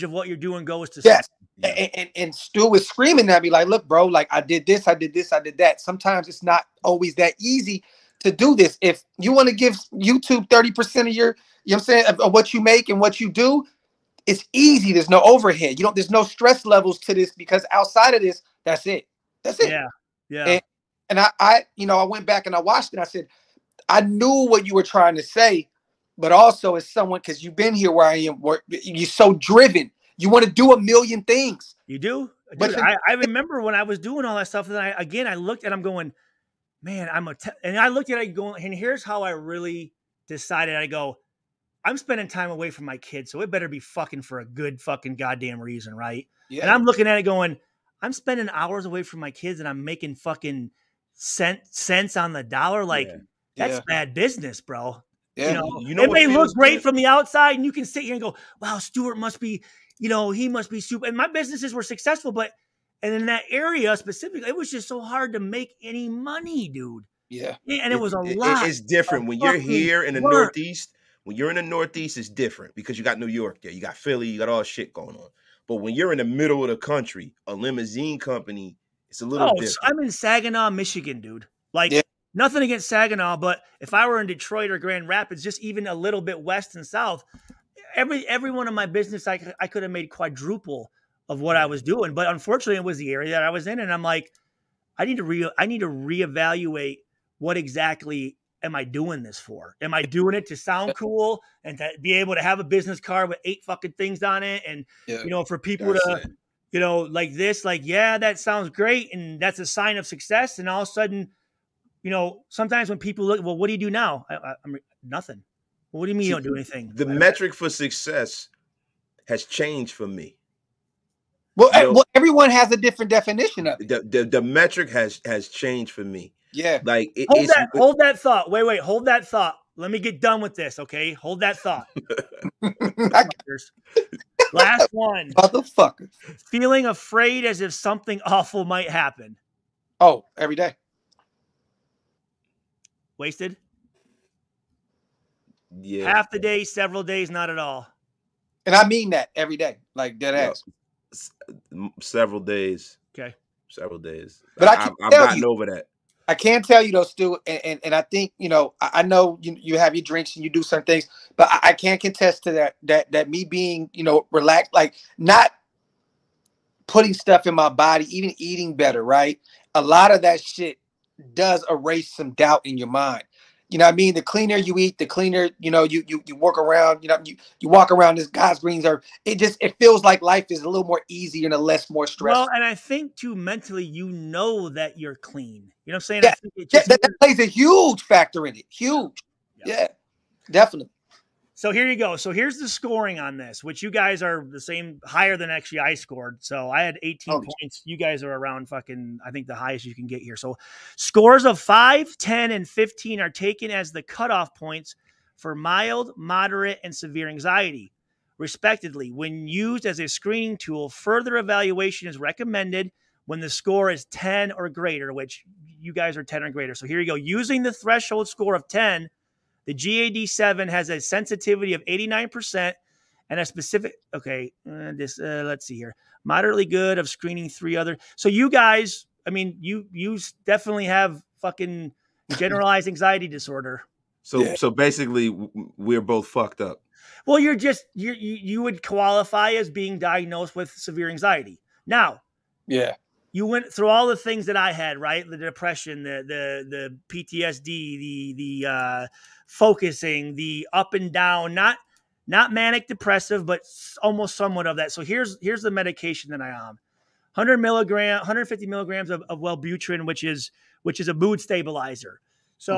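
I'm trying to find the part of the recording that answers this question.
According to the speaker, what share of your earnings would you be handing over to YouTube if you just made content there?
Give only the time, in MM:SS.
00:10.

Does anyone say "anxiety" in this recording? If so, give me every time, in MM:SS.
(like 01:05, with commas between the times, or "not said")
03:27, 03:52, 04:01.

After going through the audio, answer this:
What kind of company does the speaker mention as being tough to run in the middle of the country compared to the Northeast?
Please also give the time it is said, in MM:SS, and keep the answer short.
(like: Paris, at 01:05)
Limousine company, at 01:17.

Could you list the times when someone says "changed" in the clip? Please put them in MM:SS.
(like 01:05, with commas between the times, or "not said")
01:59, 02:05.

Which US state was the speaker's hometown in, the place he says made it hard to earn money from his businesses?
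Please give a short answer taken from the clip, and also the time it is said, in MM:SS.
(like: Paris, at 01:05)
Michigan, at 01:20.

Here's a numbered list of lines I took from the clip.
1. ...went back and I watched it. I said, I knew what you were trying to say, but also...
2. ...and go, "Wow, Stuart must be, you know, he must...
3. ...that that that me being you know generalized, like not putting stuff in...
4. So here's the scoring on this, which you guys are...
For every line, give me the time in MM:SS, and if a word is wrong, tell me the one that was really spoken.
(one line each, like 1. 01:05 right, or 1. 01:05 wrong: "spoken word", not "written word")
1. 00:22 right
2. 00:58 right
3. 02:42 wrong: "relaxed", not "generalized"
4. 03:12 right.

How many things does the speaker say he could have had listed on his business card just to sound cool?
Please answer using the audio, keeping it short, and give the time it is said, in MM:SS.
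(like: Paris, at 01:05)
8, at 01:43.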